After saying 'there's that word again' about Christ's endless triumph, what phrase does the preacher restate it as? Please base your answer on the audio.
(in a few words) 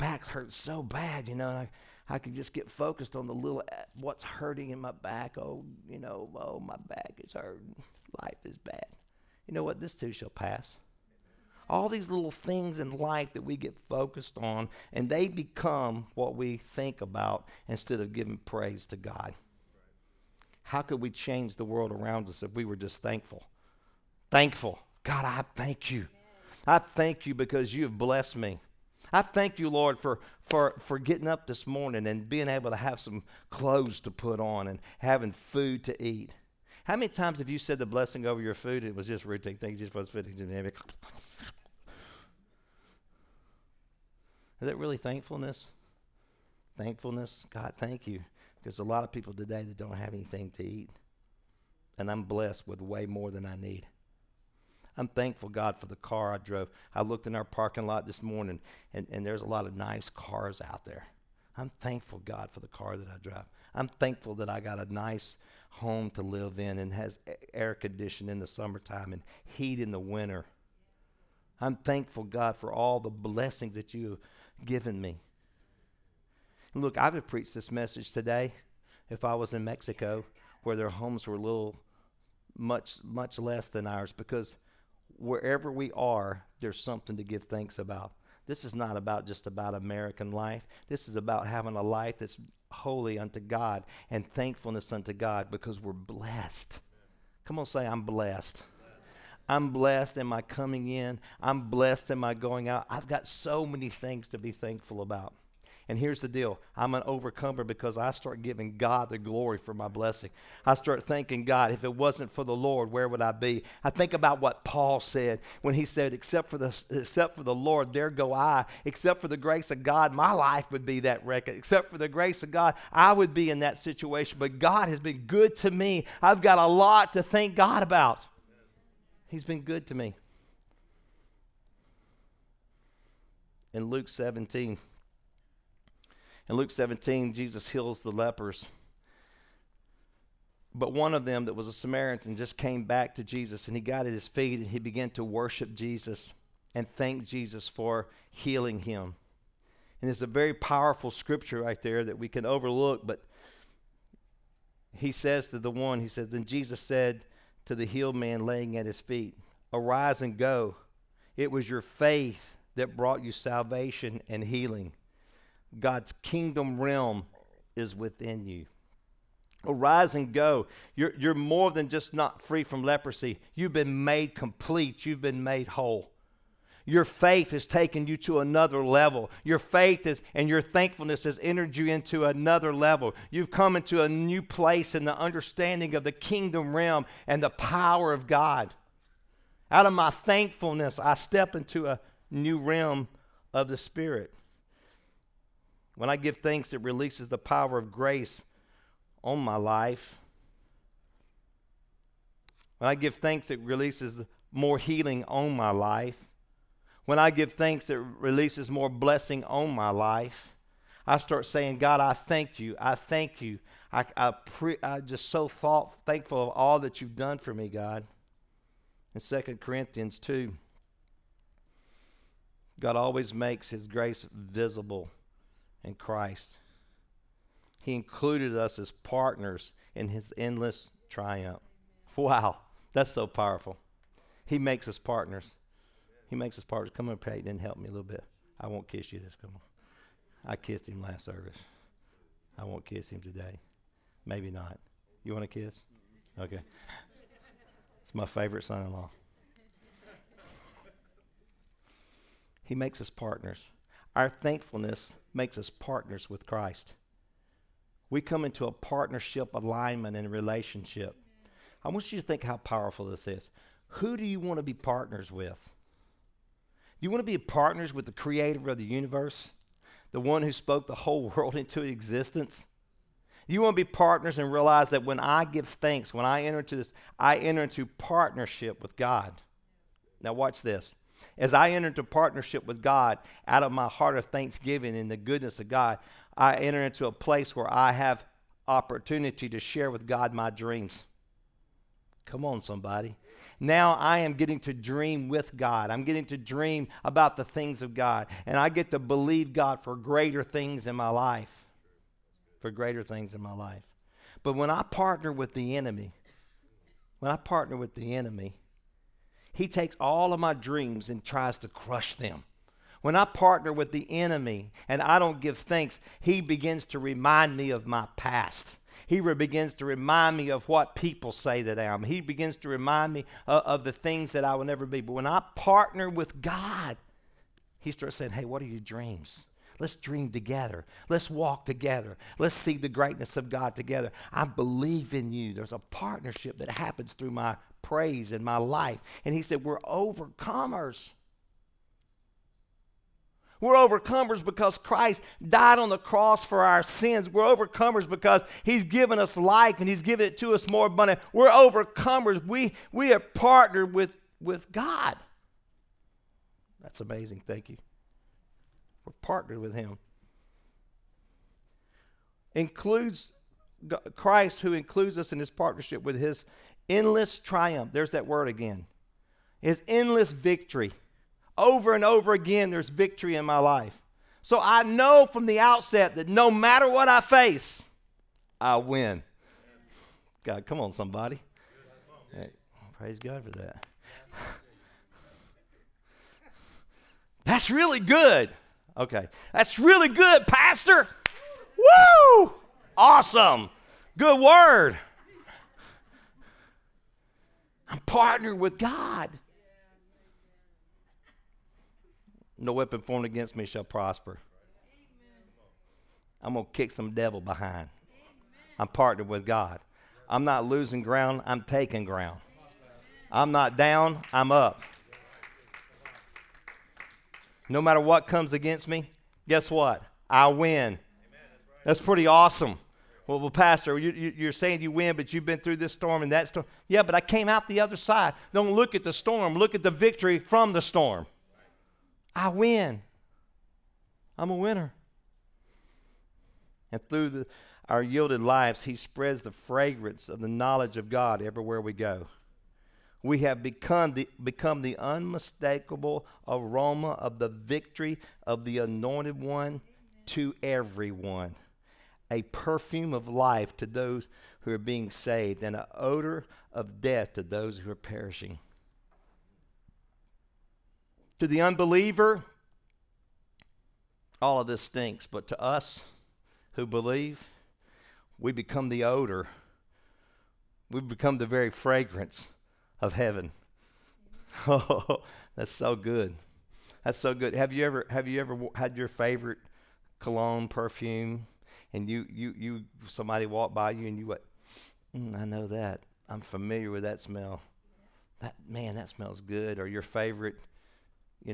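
endless victory.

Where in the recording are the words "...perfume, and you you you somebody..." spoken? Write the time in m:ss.
8:00.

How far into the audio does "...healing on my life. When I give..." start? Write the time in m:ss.
3:24.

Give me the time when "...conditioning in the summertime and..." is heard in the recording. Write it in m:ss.
1:07.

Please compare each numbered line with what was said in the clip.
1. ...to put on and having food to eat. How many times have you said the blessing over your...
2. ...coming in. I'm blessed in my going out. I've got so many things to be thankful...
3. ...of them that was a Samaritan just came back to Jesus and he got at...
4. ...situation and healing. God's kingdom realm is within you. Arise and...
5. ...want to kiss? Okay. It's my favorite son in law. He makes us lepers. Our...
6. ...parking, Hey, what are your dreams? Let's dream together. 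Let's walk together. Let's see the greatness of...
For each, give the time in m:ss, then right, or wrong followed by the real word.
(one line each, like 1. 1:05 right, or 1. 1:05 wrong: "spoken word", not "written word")
1. 0:34 right
2. 1:40 right
3. 2:21 right
4. 2:43 wrong: "salvation", not "situation"
5. 4:05 wrong: "partners", not "lepers"
6. 5:28 wrong: "saying", not "parking".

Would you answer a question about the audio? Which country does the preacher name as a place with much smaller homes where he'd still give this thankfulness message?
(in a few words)
Mexico.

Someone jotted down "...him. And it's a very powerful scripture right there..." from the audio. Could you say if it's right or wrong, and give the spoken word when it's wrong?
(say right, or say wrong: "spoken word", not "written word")
right.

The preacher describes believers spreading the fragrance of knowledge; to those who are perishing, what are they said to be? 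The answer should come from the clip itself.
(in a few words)
an odor of death.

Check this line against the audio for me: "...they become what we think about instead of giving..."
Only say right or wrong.
right.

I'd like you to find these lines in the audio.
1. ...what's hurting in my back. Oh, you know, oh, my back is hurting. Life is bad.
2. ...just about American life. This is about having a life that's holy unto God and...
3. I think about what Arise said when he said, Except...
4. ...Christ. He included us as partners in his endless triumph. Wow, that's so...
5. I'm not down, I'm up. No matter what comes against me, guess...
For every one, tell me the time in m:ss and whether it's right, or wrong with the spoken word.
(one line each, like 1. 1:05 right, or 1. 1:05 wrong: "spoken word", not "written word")
1. 0:04 right
2. 1:29 right
3. 1:53 wrong: "Paul", not "Arise"
4. 3:45 right
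5. 6:53 right.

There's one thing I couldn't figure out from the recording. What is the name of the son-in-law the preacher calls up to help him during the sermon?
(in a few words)
Peyton.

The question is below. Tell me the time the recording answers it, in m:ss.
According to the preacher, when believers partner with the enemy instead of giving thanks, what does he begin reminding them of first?
5:17.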